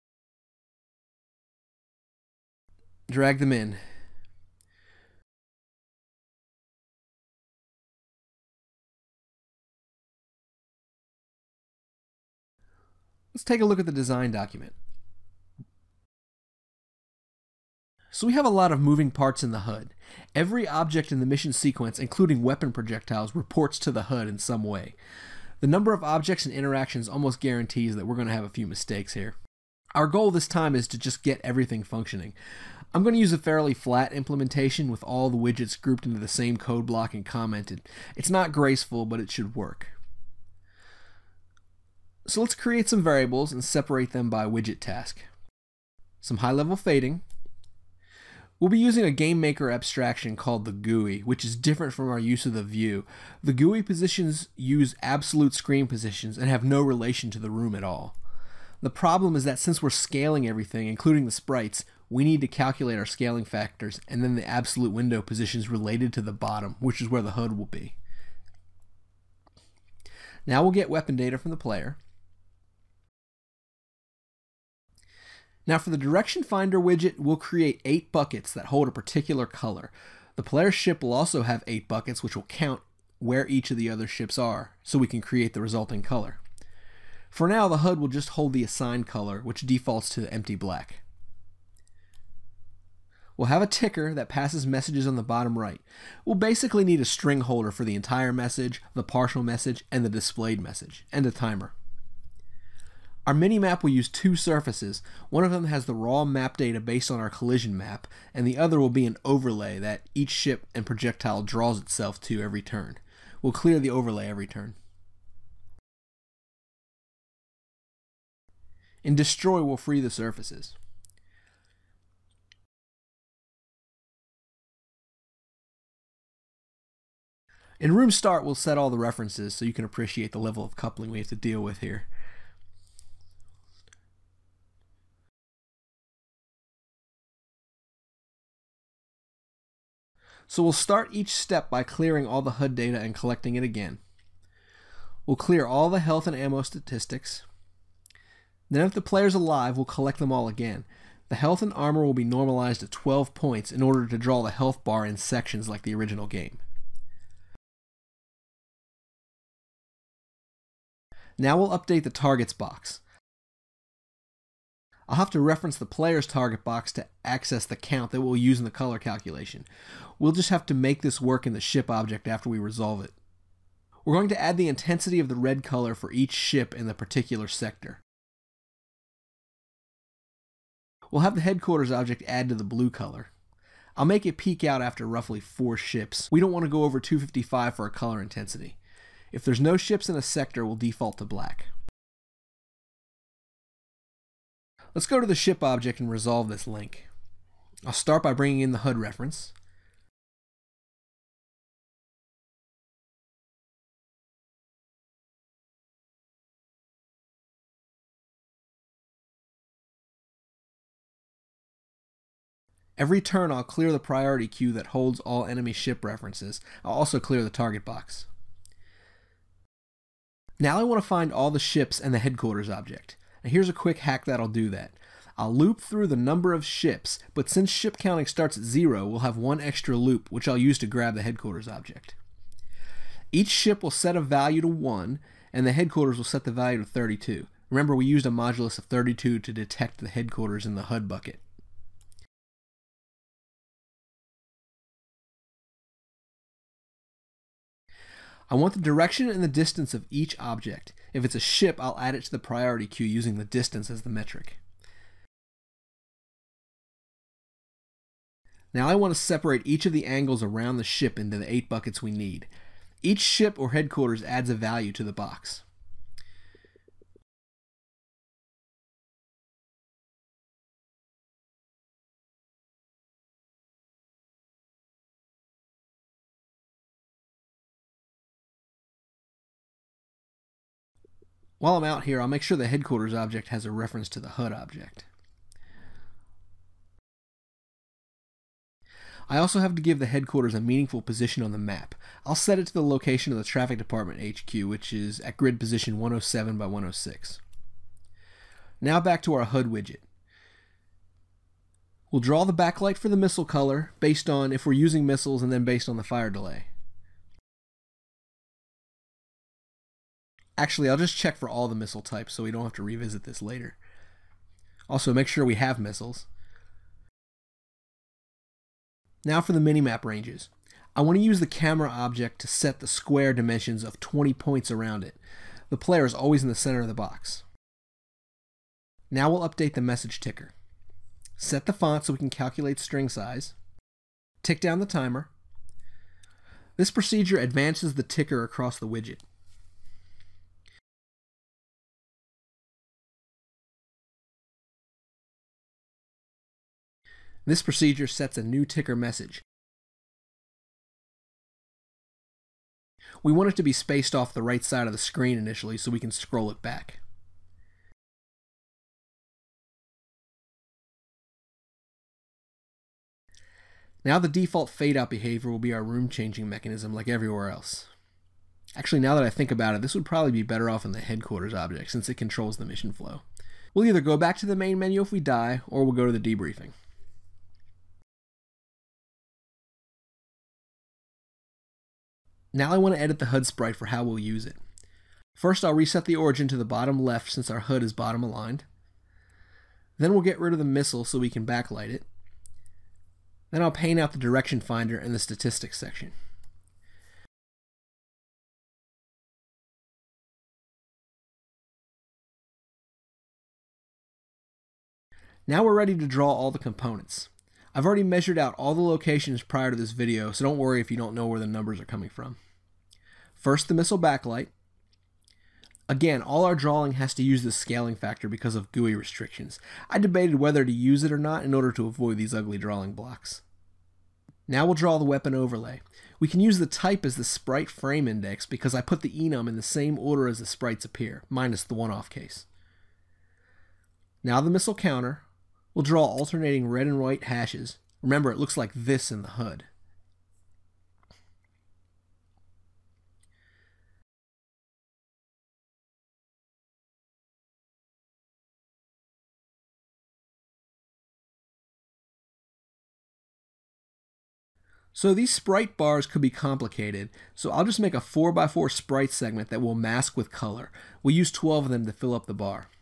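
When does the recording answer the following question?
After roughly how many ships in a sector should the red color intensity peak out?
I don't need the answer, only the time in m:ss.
3:05.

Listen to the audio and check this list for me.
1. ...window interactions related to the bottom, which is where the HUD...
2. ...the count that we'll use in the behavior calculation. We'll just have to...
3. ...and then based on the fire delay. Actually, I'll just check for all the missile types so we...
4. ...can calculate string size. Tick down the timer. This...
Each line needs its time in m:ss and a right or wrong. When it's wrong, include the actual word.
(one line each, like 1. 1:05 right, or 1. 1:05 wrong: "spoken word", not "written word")
1. 1:04 wrong: "positions", not "interactions"
2. 2:47 wrong: "color", not "behavior"
3. 5:05 right
4. 5:32 right.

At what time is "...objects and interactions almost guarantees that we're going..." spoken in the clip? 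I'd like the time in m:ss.
0:26.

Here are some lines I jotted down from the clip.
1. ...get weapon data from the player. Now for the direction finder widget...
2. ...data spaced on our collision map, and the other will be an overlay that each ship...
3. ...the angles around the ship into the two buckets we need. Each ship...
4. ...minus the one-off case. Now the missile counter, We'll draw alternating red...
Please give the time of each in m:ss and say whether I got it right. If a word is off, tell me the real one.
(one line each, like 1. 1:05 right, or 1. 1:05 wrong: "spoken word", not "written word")
1. 1:10 right
2. 1:46 wrong: "based", not "spaced"
3. 4:19 wrong: "eight", not "two"
4. 7:11 right.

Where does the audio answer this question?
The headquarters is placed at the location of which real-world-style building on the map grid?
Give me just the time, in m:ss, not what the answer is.
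4:53.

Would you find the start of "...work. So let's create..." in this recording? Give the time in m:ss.
0:39.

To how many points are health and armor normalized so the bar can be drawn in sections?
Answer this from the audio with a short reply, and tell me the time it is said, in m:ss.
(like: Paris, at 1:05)
12, at 2:32.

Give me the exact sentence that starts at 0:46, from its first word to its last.
Some high level fading, We'll be using a GameMaker abstraction called the GUI, which is different from our use of the view.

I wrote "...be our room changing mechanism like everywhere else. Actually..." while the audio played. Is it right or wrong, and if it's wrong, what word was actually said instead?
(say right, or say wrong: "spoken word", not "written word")
right.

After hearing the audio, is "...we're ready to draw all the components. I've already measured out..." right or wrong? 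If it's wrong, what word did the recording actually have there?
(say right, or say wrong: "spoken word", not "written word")
right.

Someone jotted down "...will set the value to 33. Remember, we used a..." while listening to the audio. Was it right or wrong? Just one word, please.
wrong.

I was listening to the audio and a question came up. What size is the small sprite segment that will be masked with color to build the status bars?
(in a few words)
4x4.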